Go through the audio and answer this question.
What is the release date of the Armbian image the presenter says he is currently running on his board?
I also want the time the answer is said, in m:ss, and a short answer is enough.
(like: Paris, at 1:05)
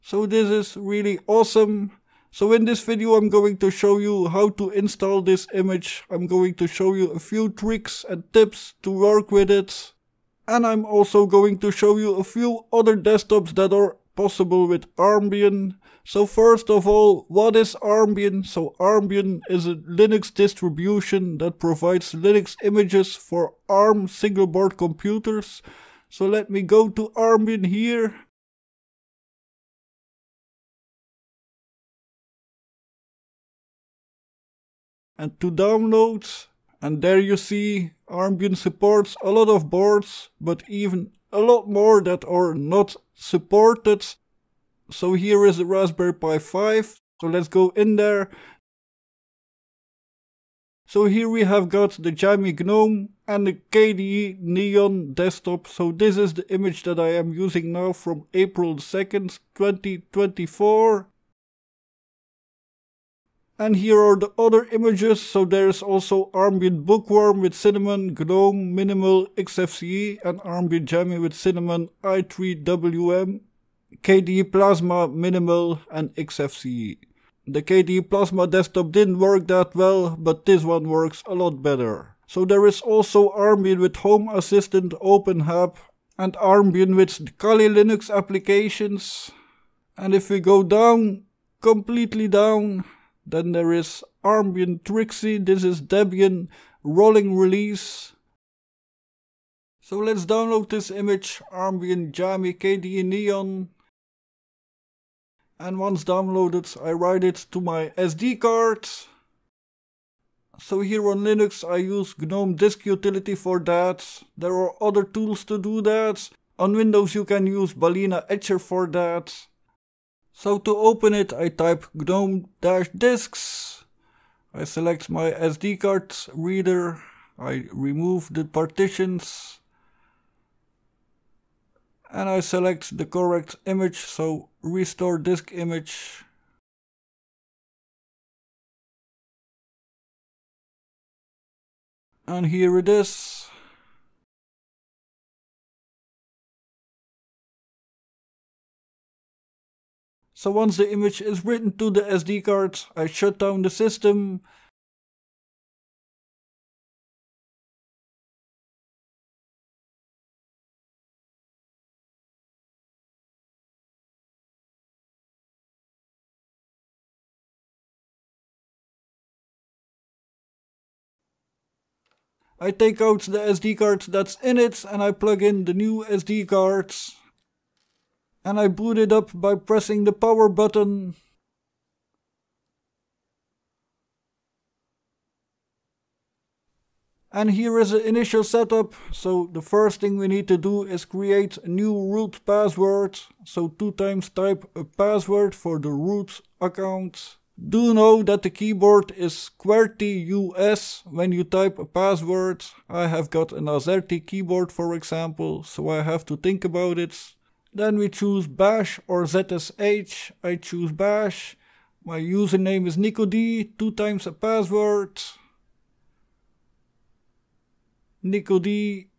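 April 2, 2024, at 0:58.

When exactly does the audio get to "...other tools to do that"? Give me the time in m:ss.
1:54.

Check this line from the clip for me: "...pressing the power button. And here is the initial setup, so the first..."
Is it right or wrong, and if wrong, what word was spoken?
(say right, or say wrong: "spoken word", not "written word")
right.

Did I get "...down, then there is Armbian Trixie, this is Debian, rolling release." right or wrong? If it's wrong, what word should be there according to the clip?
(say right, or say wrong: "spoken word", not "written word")
right.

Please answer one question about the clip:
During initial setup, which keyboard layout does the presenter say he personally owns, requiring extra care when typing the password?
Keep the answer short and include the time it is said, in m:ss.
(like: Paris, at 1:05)
AZERTY, at 3:23.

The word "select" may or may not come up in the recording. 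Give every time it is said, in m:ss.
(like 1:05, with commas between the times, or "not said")
2:04, 2:12.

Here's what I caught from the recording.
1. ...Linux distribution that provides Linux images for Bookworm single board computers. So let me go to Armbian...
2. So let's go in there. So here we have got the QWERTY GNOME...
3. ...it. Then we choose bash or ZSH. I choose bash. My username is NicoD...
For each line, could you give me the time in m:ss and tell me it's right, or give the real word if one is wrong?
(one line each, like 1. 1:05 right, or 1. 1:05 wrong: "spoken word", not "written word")
1. 0:19 wrong: "ARM", not "Bookworm"
2. 0:47 wrong: "Jammy", not "QWERTY"
3. 3:26 right.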